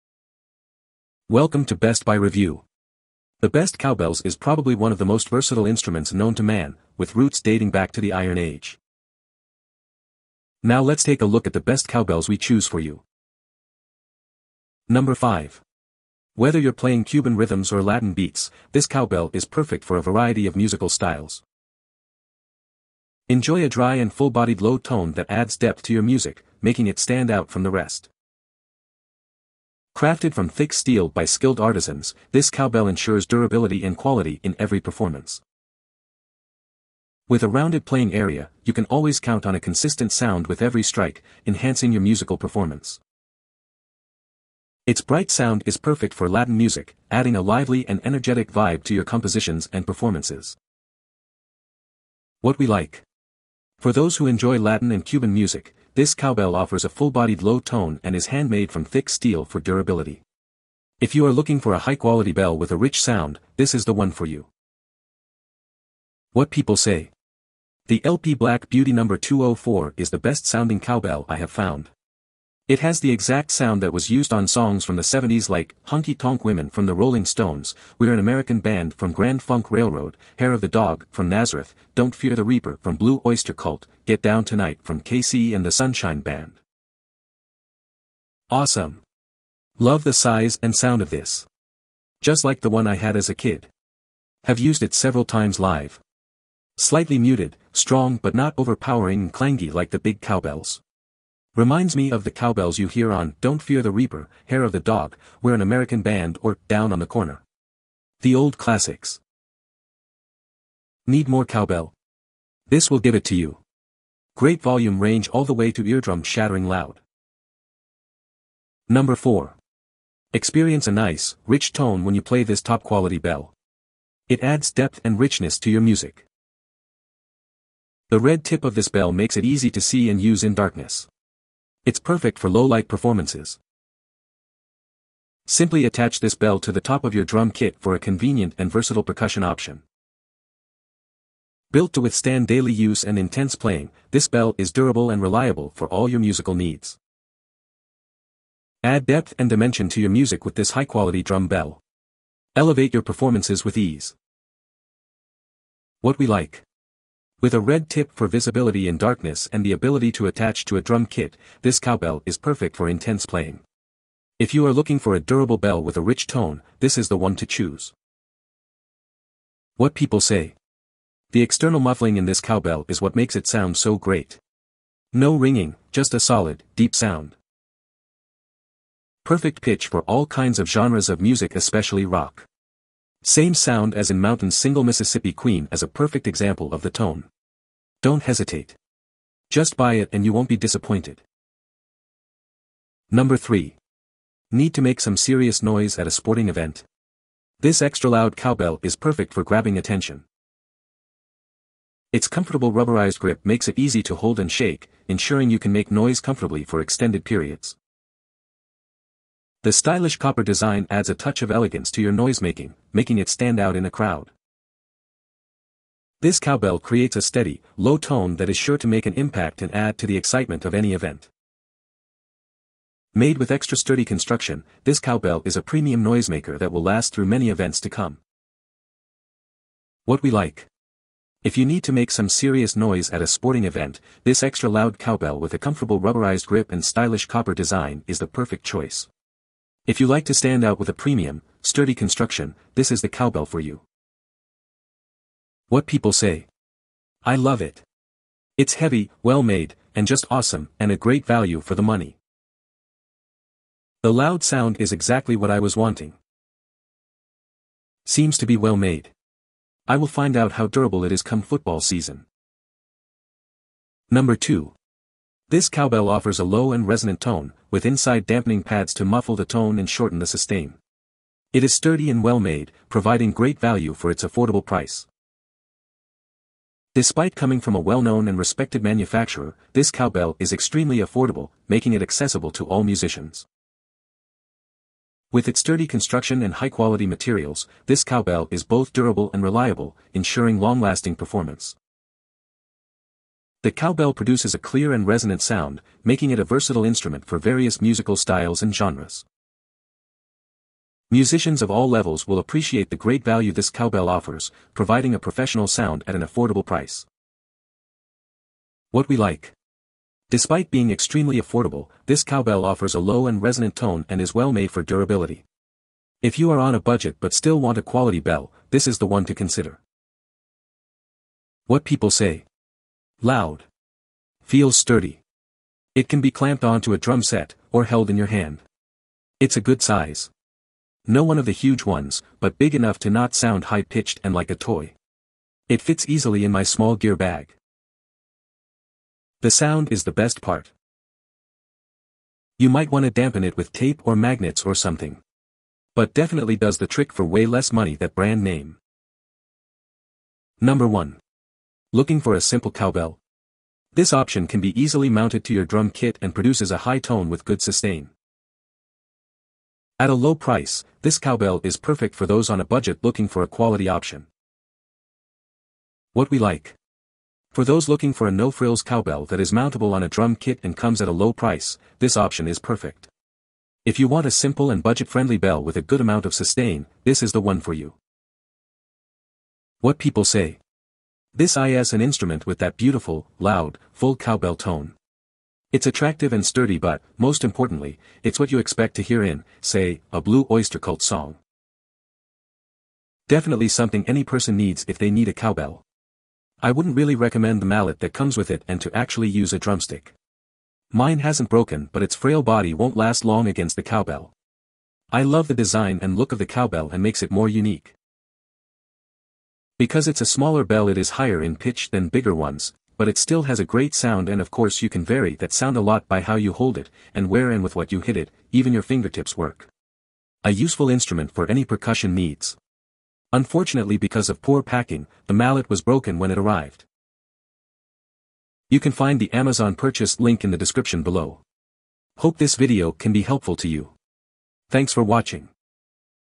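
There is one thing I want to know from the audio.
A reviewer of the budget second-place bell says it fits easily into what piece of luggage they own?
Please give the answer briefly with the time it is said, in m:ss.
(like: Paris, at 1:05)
small gear bag, at 5:36.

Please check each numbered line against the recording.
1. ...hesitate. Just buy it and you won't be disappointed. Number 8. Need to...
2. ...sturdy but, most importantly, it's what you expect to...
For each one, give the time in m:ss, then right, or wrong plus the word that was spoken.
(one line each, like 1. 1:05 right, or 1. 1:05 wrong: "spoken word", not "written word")
1. 3:08 wrong: "3", not "8"
2. 6:26 right.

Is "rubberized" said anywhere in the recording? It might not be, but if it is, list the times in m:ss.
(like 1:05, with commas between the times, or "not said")
3:22, 3:55.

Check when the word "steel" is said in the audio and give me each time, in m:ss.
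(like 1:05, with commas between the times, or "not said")
0:30, 0:59.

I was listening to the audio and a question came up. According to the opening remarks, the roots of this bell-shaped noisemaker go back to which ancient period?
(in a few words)
Iron Age.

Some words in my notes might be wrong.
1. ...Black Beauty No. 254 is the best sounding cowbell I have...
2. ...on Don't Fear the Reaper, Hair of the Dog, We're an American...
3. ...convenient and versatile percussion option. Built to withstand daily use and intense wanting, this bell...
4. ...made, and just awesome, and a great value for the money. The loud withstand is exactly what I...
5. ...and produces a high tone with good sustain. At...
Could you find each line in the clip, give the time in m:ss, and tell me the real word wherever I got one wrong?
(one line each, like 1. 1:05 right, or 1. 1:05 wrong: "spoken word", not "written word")
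1. 1:08 wrong: "204", not "254"
2. 1:43 right
3. 2:17 wrong: "playing", not "wanting"
4. 4:09 wrong: "sound", not "withstand"
5. 5:56 right.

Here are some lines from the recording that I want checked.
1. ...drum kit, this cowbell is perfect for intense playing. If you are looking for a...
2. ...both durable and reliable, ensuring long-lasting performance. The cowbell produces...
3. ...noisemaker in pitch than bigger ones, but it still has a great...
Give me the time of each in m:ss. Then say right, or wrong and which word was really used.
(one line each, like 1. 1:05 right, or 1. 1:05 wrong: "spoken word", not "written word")
1. 2:40 right
2. 4:48 right
3. 6:51 wrong: "higher", not "noisemaker".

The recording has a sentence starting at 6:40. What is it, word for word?
Mine hasn't broken but its frail body won't last long against the cowbell.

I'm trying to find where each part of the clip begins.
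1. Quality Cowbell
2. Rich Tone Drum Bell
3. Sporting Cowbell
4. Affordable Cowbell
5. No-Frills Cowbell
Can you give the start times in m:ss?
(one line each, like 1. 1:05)
1. 0:13
2. 1:57
3. 3:11
4. 4:22
5. 5:49.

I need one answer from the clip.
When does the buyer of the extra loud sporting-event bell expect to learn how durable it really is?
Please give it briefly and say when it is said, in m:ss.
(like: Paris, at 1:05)
football season, at 4:21.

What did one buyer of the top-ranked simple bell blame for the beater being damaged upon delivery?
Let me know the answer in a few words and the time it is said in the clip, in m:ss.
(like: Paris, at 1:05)
poor packing, at 7:04.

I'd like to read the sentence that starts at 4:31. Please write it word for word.
It is sturdy and well made, providing great value for its affordable price.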